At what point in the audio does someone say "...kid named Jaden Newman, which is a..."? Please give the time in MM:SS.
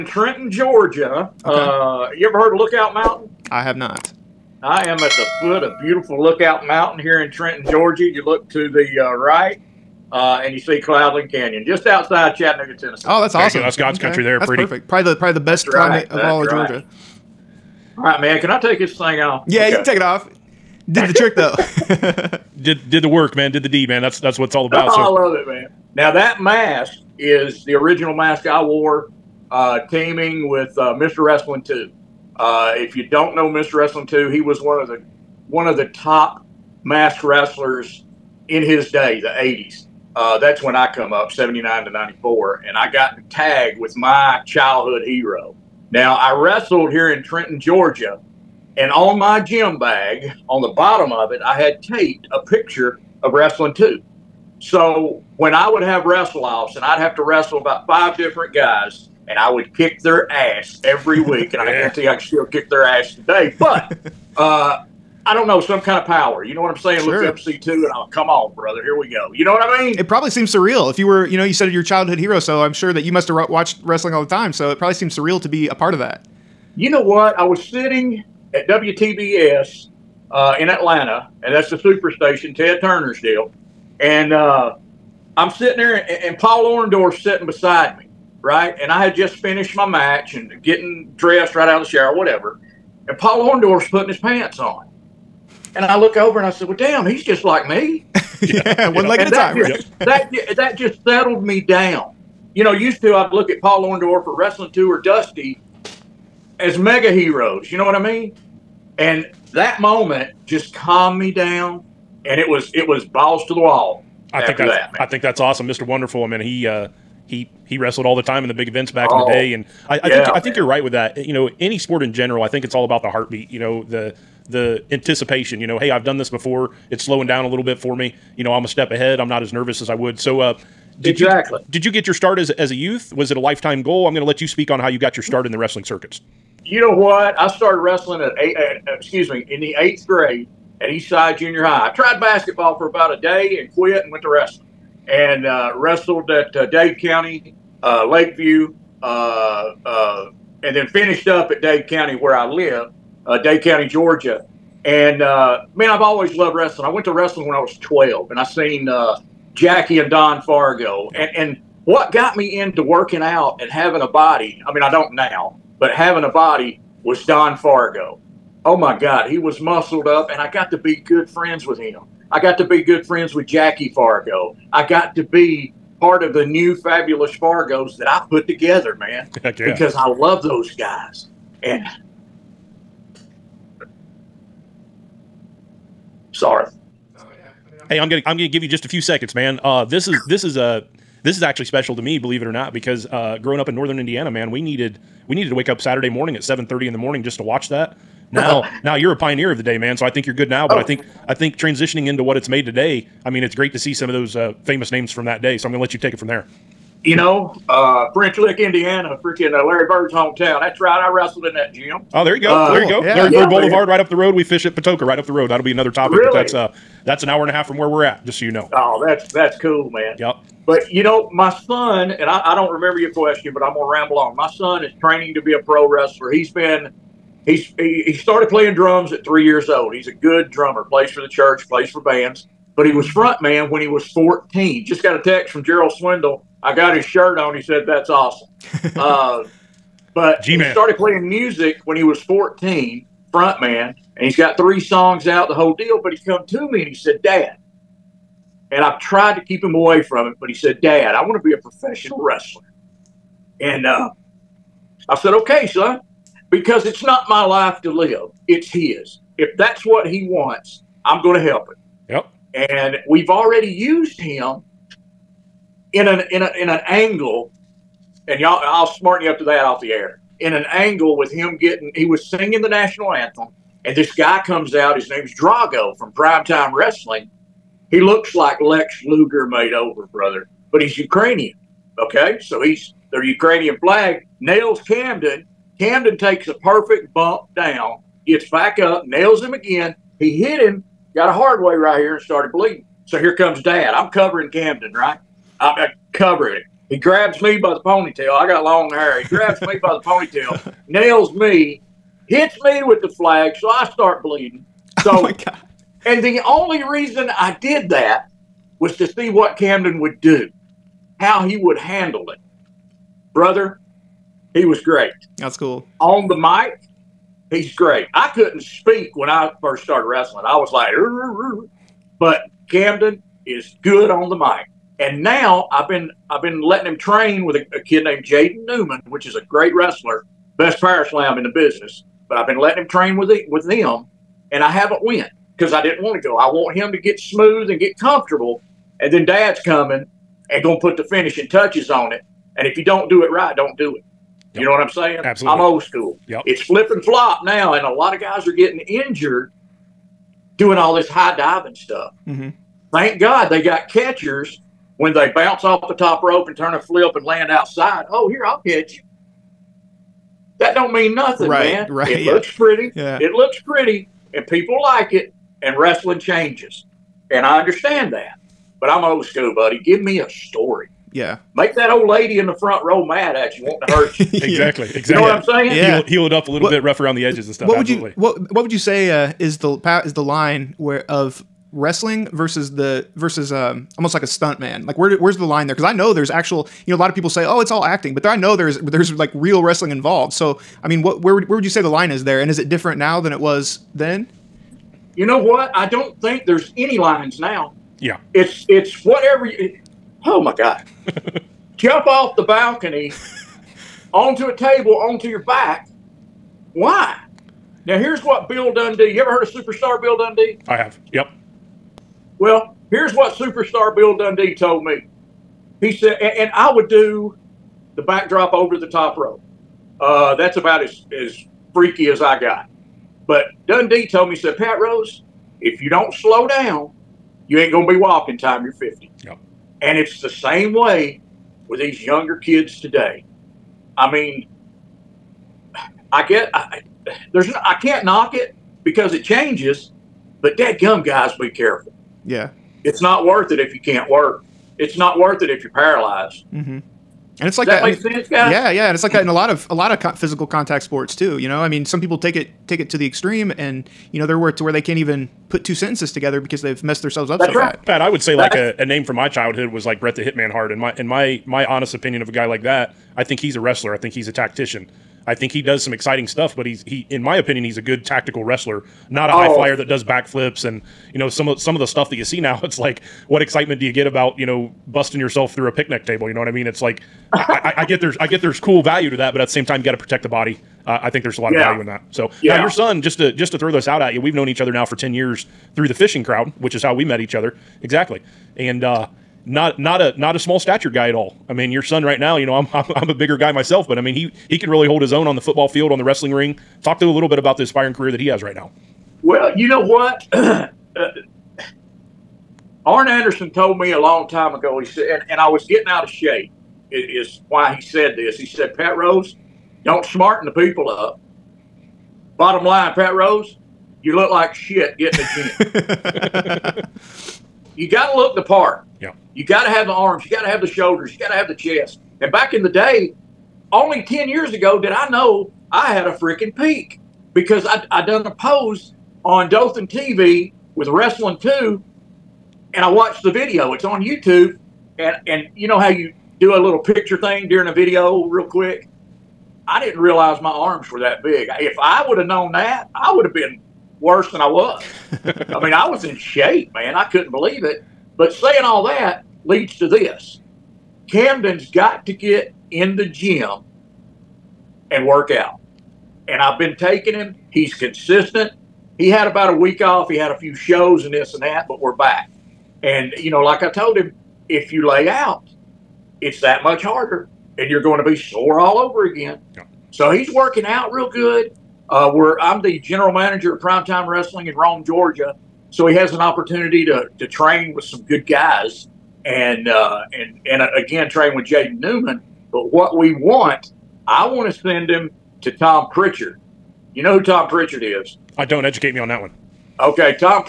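05:27.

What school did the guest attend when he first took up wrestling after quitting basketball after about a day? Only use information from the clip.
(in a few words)
Eastside Junior High.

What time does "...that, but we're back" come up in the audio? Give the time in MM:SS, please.
09:21.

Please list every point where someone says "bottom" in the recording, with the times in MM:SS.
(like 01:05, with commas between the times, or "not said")
00:50, 08:32.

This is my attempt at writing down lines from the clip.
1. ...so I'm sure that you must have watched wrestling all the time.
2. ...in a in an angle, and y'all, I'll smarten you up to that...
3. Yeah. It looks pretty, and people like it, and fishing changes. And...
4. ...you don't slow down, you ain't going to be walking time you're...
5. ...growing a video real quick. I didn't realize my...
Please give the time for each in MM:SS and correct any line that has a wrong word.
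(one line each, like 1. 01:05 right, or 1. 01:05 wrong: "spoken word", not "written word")
1. 01:12 right
2. 04:26 right
3. 06:02 wrong: "wrestling", not "fishing"
4. 07:05 right
5. 08:57 wrong: "during", not "growing".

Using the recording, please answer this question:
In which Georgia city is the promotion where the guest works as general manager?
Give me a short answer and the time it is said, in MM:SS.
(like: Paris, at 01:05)
Rome, at 09:34.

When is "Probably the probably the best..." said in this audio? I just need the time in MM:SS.
00:14.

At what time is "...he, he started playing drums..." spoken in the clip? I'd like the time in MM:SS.
03:47.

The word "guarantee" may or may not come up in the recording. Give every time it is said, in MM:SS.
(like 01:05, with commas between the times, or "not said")
01:01.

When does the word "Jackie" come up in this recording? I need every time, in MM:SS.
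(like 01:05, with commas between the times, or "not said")
02:39, 02:53.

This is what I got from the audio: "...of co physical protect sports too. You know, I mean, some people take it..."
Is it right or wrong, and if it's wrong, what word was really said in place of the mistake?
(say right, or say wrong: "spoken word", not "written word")
wrong: "contact", not "protect".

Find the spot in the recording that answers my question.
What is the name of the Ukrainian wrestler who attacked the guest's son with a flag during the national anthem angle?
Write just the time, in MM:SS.
04:35.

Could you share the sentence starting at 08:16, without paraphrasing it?
Talk to a little bit about the aspiring career that he has right now.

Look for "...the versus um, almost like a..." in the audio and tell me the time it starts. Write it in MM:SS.
06:22.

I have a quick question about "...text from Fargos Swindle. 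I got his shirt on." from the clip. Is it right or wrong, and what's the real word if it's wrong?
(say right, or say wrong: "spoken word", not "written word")
wrong: "Gerald", not "Fargos".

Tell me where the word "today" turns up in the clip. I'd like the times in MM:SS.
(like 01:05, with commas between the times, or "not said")
01:03, 03:22, 07:12.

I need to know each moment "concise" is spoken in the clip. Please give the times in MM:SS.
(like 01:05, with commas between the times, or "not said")
not said.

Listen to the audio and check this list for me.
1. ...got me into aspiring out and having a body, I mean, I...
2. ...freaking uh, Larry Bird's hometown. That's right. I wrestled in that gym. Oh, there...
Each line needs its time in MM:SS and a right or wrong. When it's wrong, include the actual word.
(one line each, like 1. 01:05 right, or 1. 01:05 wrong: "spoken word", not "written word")
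1. 02:42 wrong: "working", not "aspiring"
2. 03:29 right.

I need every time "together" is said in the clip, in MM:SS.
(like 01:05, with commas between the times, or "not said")
02:58, 07:36.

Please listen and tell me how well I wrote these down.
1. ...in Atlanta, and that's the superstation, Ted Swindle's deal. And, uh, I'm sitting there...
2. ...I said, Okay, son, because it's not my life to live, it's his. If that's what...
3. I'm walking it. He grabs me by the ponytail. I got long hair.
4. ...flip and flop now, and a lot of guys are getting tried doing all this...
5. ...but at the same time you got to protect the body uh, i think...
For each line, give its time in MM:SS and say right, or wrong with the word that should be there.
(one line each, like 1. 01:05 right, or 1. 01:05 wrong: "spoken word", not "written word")
1. 01:20 wrong: "Turner", not "Swindle"
2. 04:15 right
3. 04:55 wrong: "covering", not "walking"
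4. 05:46 wrong: "injured", not "tried"
5. 07:59 right.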